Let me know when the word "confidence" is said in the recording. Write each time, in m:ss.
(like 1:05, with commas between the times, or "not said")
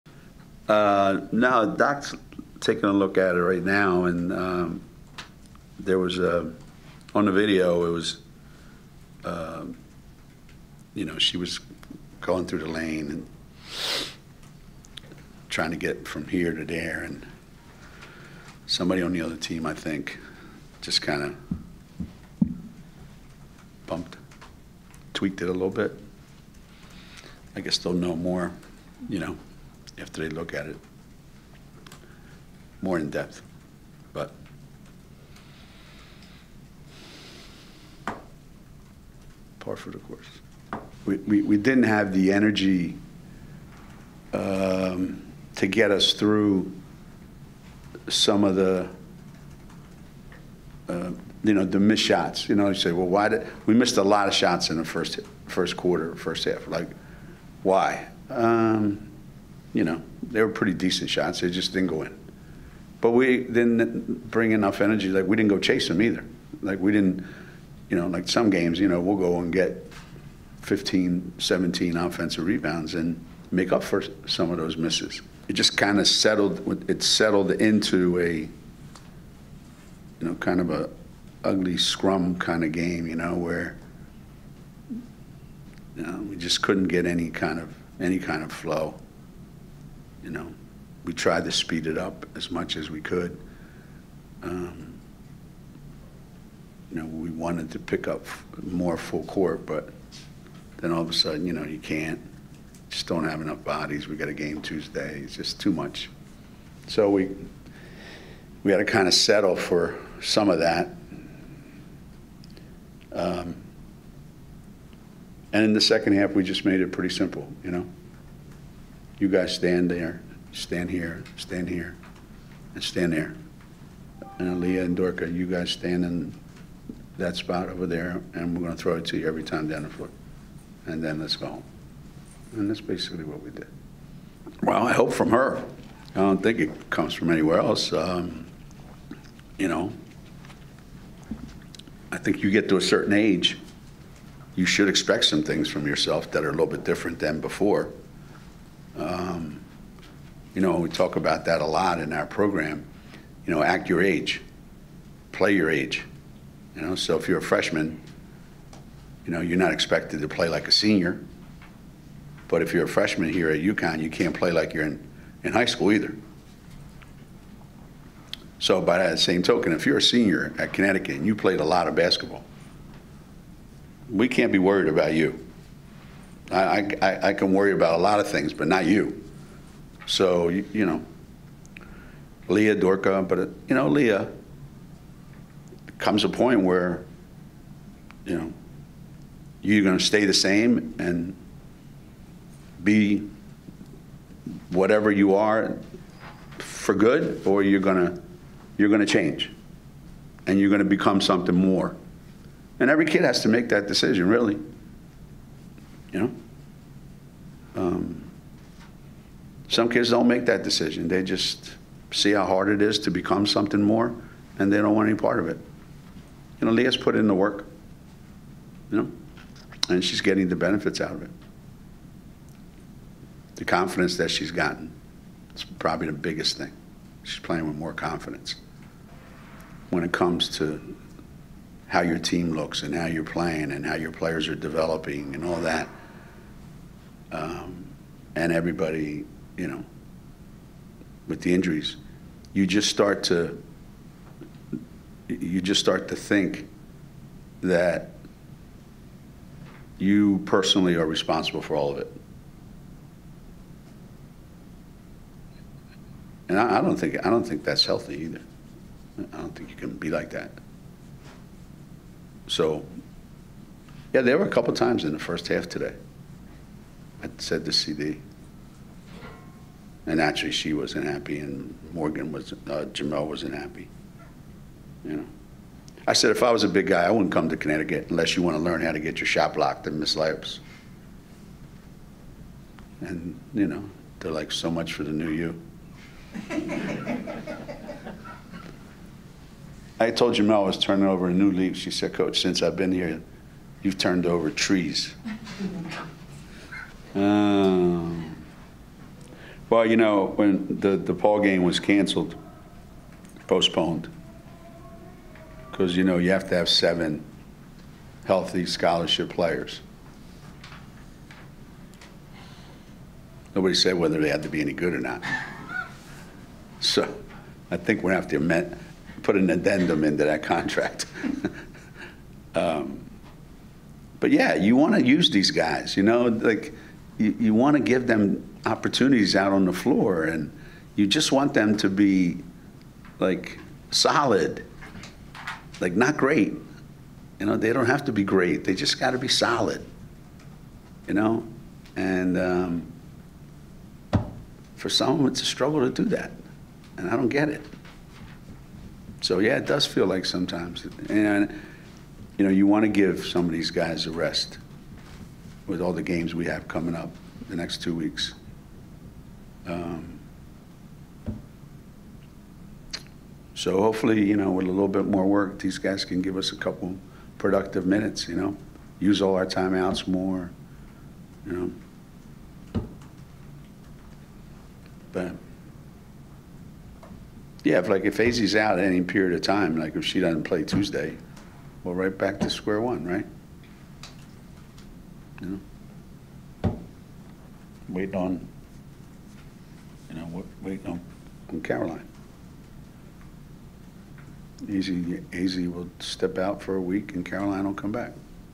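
3:43, 3:47.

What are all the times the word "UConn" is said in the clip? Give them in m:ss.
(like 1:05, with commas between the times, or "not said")
2:43.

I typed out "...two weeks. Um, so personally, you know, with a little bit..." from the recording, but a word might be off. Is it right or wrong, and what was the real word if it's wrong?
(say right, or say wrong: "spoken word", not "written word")
wrong: "hopefully", not "personally".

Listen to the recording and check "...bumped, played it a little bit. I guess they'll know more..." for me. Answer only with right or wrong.
wrong.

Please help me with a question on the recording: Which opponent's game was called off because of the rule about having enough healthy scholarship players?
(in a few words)
DePaul.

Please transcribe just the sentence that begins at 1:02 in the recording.
But we didn't bring enough energy.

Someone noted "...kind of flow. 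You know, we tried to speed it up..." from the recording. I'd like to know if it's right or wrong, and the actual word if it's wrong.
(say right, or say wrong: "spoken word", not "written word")
right.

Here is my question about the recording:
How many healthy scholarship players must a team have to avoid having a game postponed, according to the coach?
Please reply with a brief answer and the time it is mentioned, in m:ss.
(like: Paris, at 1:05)
7, at 5:06.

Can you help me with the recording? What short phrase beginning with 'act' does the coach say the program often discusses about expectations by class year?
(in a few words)
act your age.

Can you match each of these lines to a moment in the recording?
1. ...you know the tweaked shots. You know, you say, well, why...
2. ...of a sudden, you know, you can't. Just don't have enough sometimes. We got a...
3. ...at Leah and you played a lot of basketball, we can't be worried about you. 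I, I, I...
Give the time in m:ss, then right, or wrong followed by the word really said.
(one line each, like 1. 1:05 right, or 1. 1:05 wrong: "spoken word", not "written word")
1. 0:51 wrong: "missed", not "tweaked"
2. 1:41 wrong: "bodies", not "sometimes"
3. 2:50 wrong: "Connecticut", not "Leah".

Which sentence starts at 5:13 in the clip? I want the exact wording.
Nobody said whether they had to be any good or not.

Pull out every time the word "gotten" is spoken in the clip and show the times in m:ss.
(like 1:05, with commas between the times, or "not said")
3:44.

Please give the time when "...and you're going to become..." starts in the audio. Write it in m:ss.
3:20.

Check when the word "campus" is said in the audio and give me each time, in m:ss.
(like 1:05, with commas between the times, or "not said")
not said.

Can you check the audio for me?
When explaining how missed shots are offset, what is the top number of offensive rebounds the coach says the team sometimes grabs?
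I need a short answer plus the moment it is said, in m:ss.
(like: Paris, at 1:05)
17, at 1:11.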